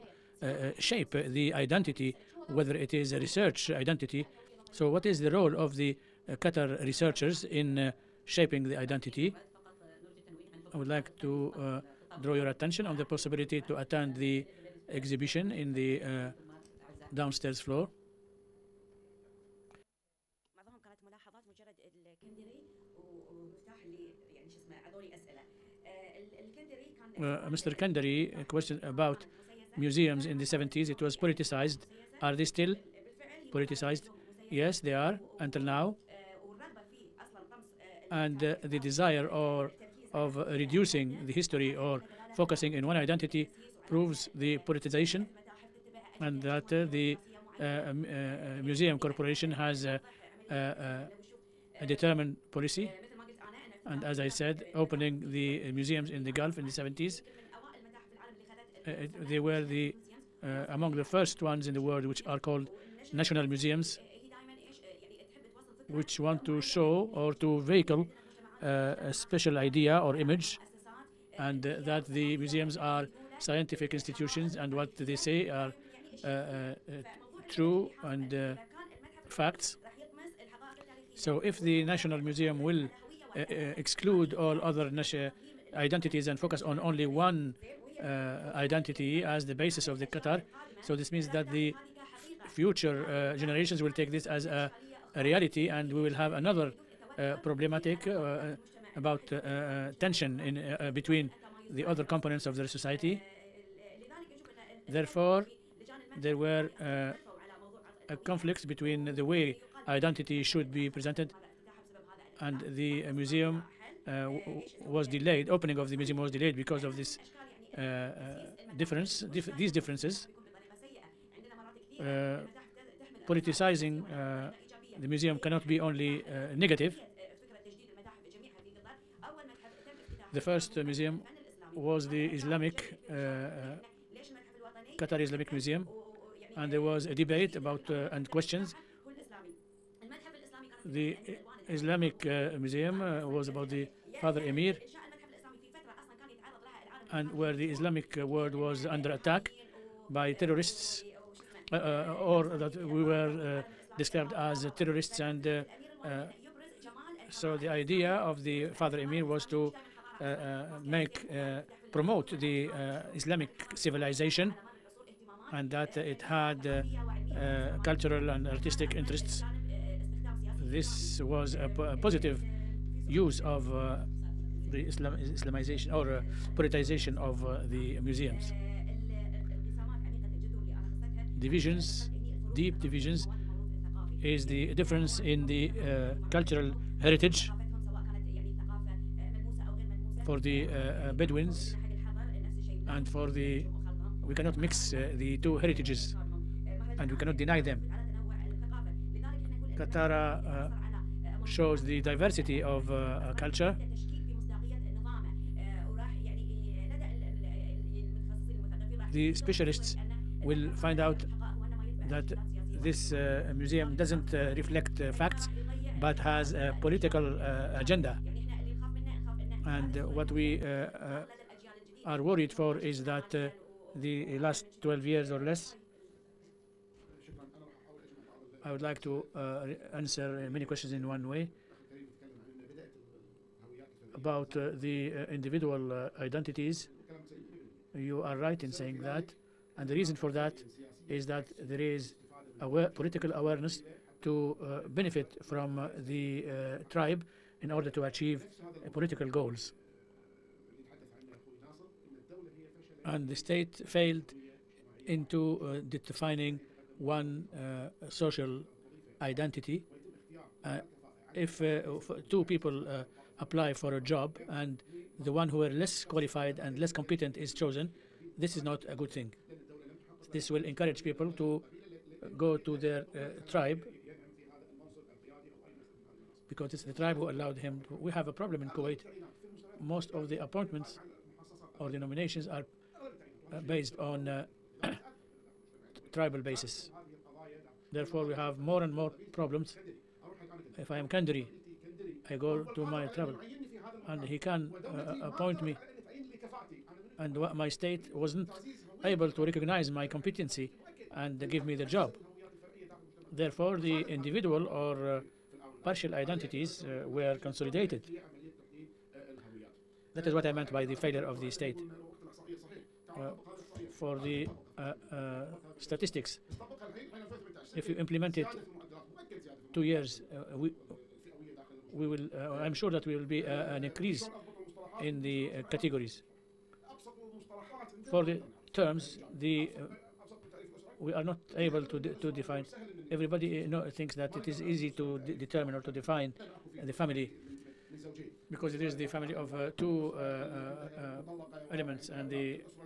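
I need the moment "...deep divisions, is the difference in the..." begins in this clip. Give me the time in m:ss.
3:02.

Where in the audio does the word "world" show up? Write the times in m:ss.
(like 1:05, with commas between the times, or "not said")
1:01, 2:28.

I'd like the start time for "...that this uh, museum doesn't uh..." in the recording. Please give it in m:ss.
3:32.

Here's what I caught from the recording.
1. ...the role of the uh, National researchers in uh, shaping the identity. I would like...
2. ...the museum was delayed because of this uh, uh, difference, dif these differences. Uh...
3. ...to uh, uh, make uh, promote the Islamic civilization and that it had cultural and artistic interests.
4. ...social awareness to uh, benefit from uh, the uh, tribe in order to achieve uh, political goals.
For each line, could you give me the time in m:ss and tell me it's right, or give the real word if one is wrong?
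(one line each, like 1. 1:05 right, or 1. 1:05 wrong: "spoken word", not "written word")
1. 0:05 wrong: "Qatar", not "National"
2. 1:55 right
3. 2:39 right
4. 4:02 wrong: "political", not "social".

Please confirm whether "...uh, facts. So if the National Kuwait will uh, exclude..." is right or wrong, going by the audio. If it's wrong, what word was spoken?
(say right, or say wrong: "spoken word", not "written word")
wrong: "Museum", not "Kuwait".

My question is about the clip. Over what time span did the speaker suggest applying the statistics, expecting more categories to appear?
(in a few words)
2 years.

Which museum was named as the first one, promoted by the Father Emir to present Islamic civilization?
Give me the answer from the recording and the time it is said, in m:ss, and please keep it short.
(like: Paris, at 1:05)
Qatar Islamic Museum, at 2:14.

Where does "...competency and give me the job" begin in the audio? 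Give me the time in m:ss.
5:00.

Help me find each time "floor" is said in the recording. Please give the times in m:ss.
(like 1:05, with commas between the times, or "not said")
0:17.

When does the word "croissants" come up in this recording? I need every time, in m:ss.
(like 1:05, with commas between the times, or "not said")
not said.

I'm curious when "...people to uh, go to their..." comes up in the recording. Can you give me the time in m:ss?
4:31.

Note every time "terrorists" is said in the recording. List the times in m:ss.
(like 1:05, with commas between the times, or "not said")
2:30, 2:34.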